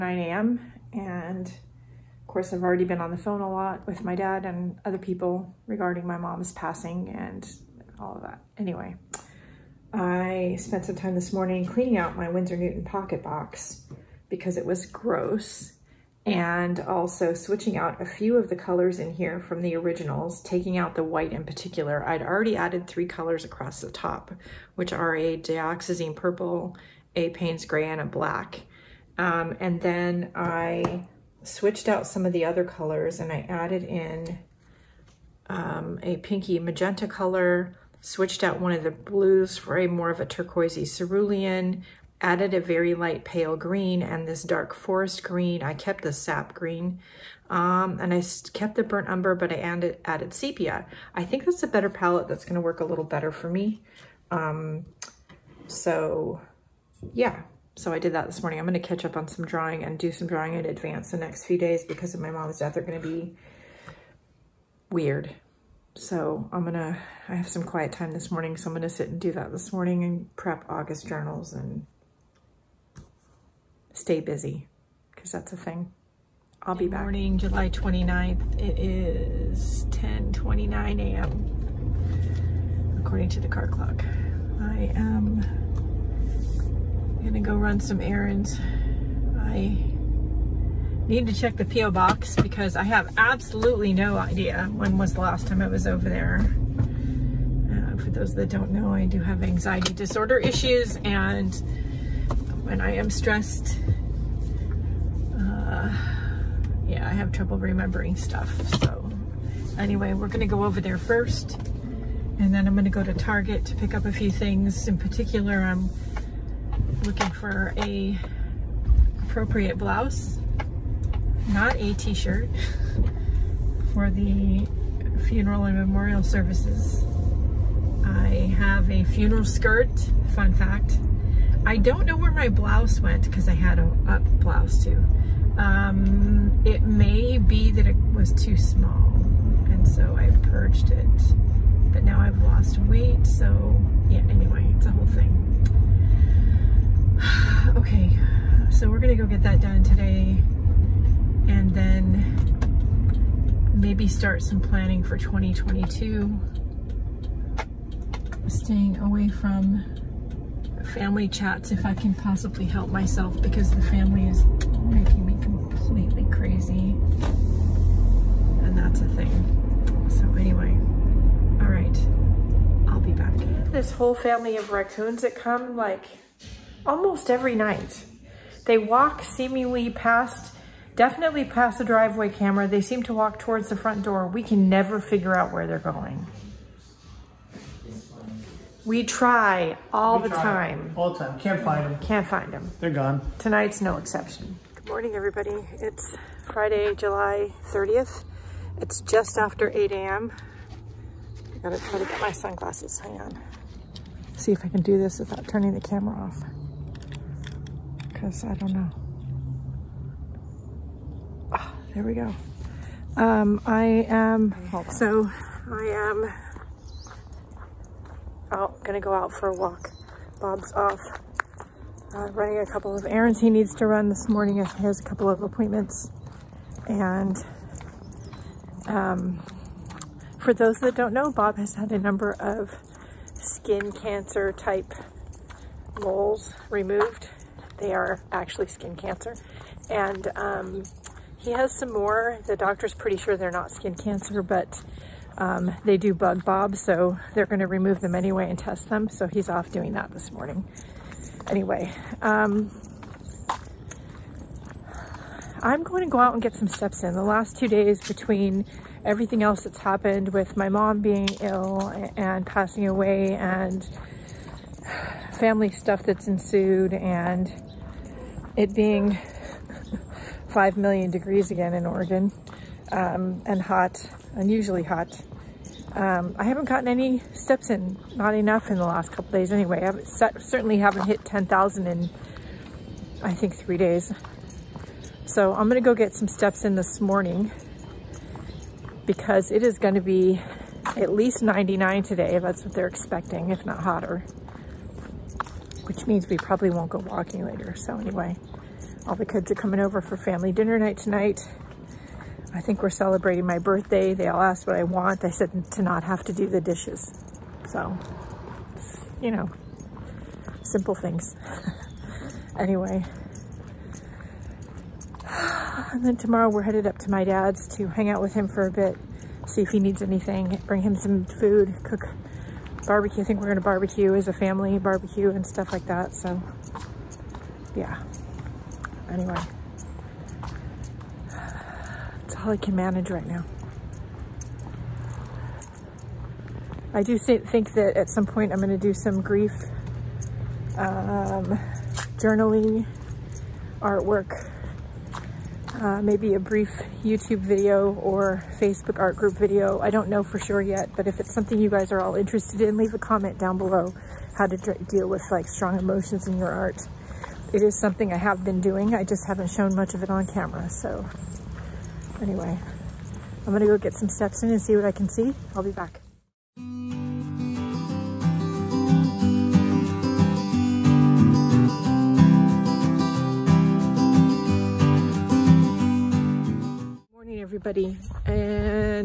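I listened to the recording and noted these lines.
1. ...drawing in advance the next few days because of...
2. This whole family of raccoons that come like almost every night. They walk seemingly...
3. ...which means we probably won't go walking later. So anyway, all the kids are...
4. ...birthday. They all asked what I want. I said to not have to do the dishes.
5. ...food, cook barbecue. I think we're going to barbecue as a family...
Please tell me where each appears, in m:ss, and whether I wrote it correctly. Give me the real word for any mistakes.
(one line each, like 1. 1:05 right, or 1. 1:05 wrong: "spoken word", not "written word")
1. 1:00 right
2. 2:53 right
3. 4:55 right
4. 5:03 right
5. 5:21 right.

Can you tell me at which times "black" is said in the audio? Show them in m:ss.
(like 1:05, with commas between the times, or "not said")
0:28.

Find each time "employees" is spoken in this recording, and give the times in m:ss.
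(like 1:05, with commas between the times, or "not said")
not said.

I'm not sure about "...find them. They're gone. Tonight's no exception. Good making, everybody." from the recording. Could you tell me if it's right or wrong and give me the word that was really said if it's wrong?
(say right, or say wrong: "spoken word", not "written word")
wrong: "morning", not "making".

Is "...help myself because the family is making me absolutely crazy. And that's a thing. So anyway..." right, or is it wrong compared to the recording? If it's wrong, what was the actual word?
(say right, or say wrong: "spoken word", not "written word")
wrong: "completely", not "absolutely".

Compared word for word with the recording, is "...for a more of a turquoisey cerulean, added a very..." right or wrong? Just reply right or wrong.
right.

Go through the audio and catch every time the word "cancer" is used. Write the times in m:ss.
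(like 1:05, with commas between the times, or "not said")
3:53, 3:58, 4:03.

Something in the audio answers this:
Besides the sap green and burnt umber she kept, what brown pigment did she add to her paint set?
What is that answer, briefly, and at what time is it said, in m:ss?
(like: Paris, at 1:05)
sepia, at 0:50.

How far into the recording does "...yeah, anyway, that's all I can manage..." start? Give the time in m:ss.
5:27.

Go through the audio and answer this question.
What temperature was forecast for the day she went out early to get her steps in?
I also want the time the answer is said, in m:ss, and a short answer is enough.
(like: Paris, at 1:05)
99, at 4:51.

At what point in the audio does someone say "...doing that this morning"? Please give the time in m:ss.
4:09.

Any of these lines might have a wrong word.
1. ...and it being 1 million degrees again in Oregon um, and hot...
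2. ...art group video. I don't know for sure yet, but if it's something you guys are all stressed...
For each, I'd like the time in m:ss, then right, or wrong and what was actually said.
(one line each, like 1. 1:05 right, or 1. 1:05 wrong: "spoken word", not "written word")
1. 4:26 wrong: "5", not "1"
2. 5:48 wrong: "interested", not "stressed".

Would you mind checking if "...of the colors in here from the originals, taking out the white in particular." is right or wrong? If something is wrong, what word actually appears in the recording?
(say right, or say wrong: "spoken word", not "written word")
right.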